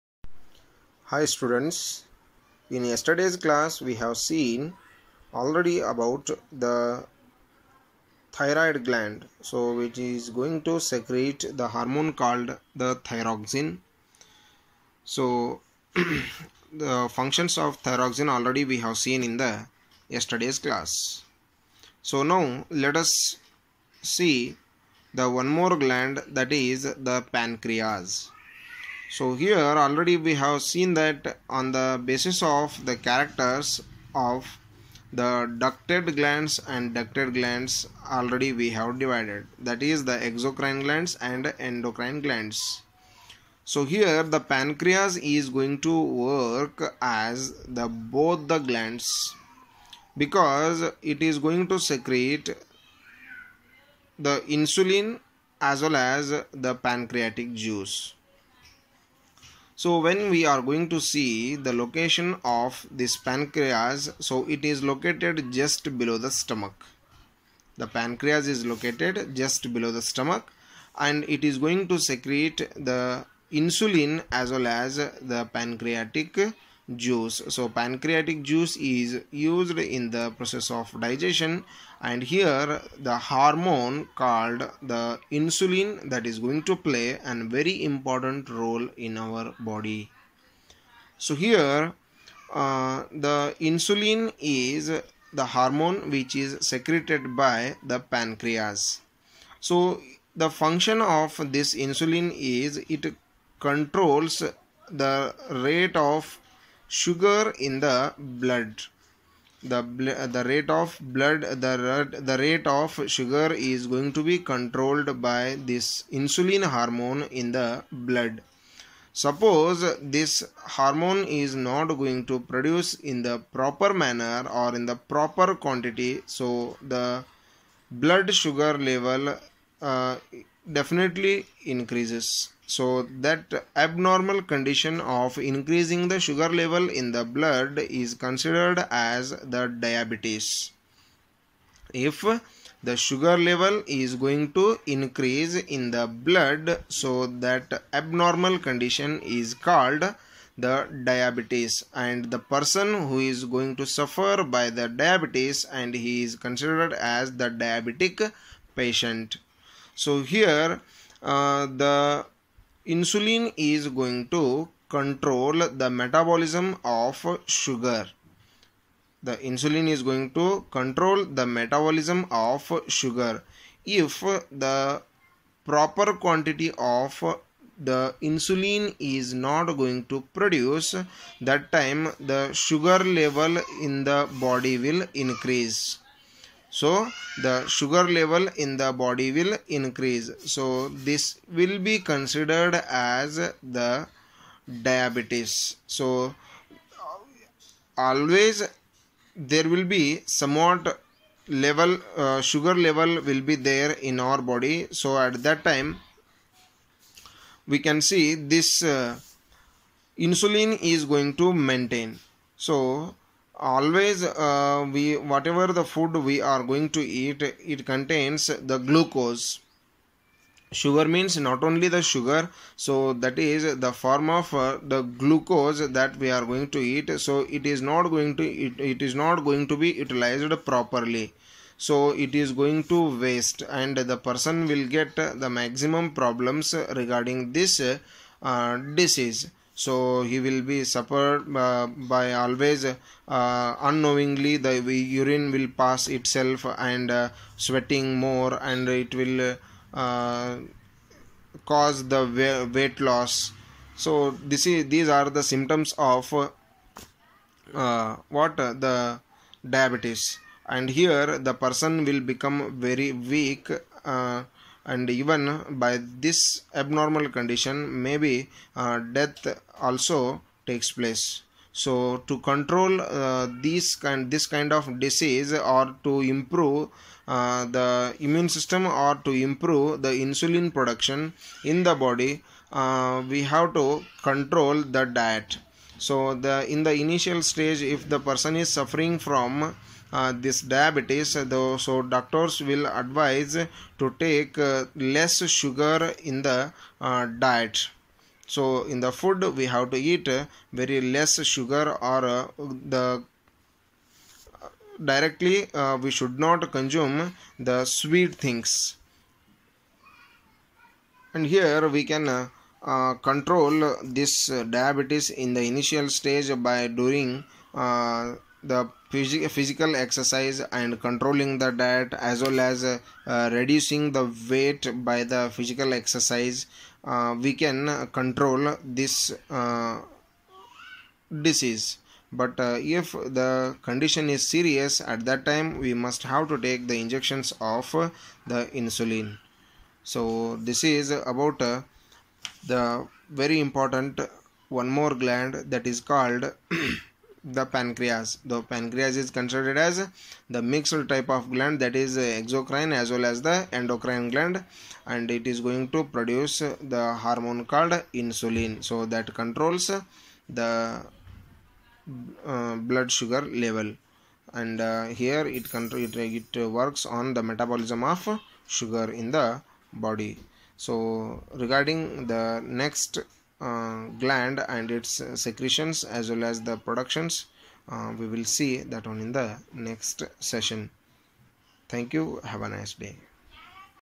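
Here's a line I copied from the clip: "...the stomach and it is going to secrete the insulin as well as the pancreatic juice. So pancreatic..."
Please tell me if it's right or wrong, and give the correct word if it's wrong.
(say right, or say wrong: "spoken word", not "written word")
right.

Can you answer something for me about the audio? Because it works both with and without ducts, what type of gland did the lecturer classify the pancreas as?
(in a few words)
mixed type.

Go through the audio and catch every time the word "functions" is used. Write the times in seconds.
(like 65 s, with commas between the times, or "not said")
17 s, 100 s.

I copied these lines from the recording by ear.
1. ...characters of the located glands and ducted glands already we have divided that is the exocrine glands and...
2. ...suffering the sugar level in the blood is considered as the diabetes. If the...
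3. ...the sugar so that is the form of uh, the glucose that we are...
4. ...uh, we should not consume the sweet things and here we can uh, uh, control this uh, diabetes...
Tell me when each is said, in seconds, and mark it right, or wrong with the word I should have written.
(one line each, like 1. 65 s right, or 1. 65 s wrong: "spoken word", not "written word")
1. 33 s wrong: "ducted", not "located"
2. 135 s wrong: "increasing", not "suffering"
3. 221 s right
4. 305 s right.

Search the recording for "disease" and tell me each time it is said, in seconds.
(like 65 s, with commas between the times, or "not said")
238 s, 274 s, 331 s.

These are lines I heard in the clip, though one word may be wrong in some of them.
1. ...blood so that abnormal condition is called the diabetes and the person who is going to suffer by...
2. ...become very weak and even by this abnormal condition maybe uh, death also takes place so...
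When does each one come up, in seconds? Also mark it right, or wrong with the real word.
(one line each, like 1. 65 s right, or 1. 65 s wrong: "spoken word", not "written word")
1. 146 s right
2. 262 s right.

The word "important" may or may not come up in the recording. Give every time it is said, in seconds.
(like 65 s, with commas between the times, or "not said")
87 s, 343 s.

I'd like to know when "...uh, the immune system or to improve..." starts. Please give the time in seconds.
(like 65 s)
277 s.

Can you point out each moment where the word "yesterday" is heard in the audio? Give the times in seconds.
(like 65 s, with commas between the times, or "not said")
2 s, 20 s.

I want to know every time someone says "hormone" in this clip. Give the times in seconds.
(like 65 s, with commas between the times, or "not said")
11 s, 83 s, 95 s, 116 s, 120 s, 357 s.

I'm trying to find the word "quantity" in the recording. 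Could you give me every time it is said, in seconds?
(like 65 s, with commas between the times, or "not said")
125 s, 176 s.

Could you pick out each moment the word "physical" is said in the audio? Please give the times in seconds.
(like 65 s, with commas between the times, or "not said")
319 s, 325 s.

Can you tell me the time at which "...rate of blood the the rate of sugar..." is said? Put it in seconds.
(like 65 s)
110 s.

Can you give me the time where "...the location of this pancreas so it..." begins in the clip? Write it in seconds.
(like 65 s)
61 s.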